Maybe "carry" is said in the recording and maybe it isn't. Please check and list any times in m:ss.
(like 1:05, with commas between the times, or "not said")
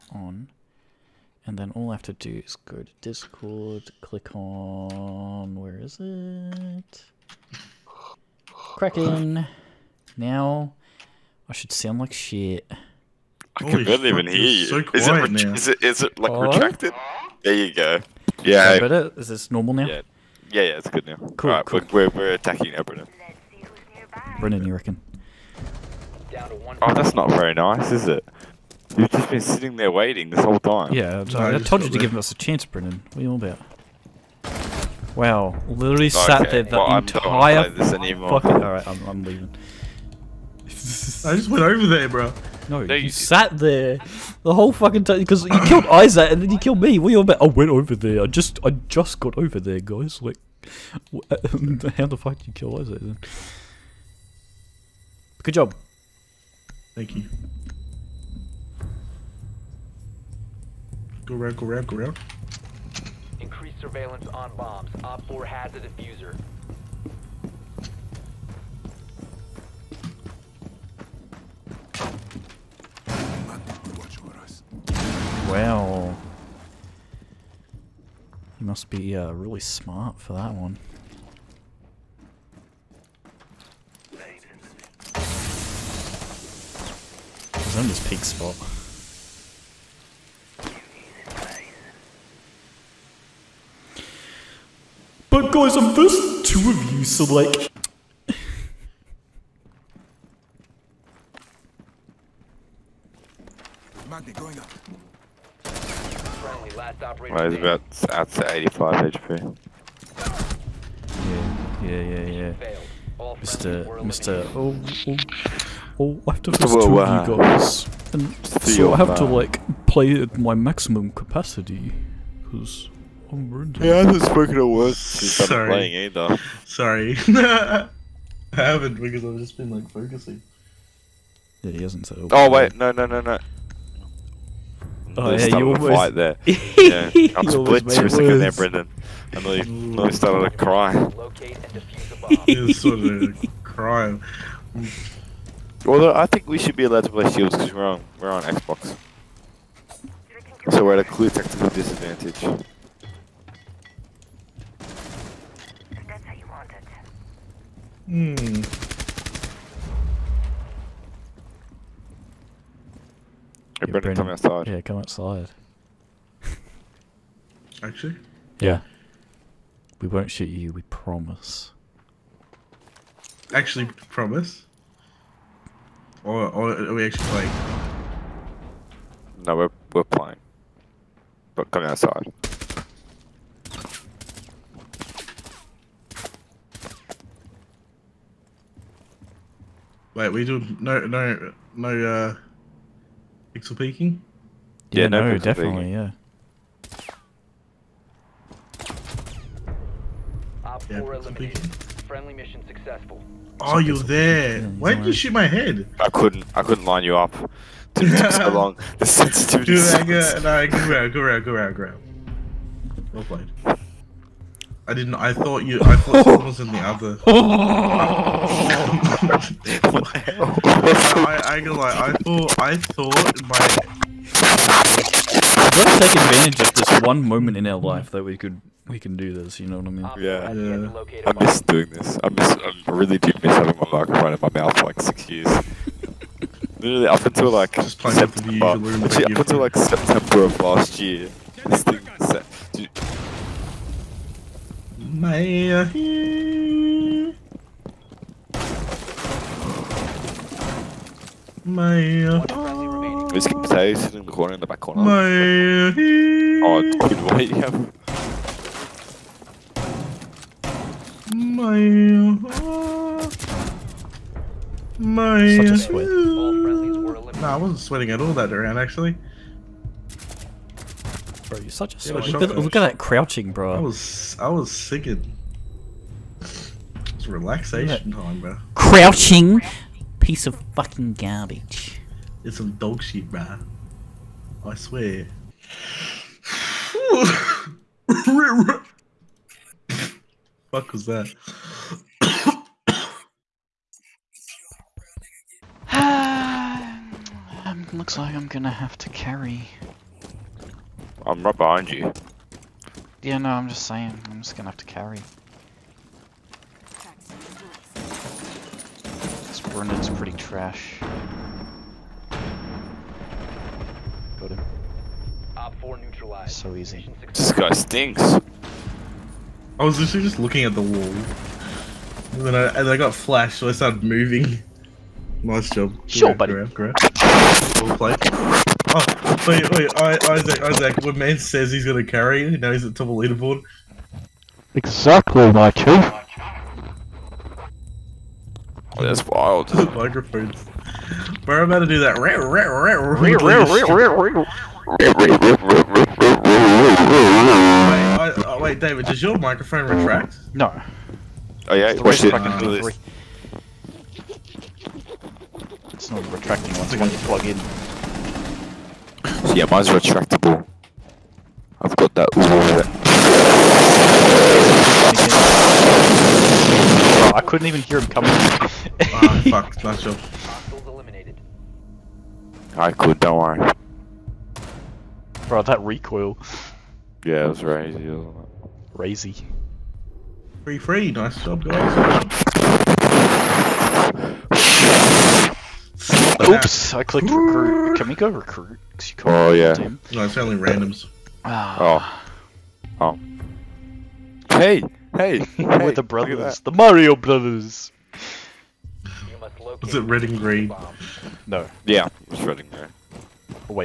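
4:59, 5:04, 5:32.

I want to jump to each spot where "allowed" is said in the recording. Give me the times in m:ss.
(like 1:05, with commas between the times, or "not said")
2:26.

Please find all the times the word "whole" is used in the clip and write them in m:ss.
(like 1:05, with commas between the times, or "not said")
0:30, 0:44.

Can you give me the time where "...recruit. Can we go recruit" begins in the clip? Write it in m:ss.
6:27.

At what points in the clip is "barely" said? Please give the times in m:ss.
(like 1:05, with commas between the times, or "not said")
0:13.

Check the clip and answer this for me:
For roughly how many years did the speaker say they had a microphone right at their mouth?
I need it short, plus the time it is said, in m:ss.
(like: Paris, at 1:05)
6, at 3:55.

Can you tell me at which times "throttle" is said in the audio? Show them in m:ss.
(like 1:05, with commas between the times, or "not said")
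not said.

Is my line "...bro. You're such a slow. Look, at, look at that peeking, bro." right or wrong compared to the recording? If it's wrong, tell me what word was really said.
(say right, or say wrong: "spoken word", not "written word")
wrong: "crouching", not "peeking".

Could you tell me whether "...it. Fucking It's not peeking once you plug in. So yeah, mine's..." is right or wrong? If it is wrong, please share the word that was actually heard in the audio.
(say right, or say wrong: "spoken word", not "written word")
wrong: "retracting", not "peeking".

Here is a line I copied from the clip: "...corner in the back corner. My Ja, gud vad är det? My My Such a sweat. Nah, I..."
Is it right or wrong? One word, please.
right.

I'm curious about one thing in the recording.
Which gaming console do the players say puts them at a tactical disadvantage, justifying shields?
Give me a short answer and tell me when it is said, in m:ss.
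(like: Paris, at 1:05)
Xbox, at 2:28.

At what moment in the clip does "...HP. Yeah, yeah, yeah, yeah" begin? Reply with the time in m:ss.
1:49.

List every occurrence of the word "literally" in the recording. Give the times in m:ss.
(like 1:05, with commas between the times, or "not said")
0:35, 3:56, 5:19.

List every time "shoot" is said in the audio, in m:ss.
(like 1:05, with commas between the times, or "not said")
2:50, 3:25.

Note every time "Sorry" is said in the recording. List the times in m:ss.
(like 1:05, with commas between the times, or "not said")
2:06.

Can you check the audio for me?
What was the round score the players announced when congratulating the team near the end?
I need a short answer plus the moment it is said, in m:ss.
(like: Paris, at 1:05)
3-3, at 6:20.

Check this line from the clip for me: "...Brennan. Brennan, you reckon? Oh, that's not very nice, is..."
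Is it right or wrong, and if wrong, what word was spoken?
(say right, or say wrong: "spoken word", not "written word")
right.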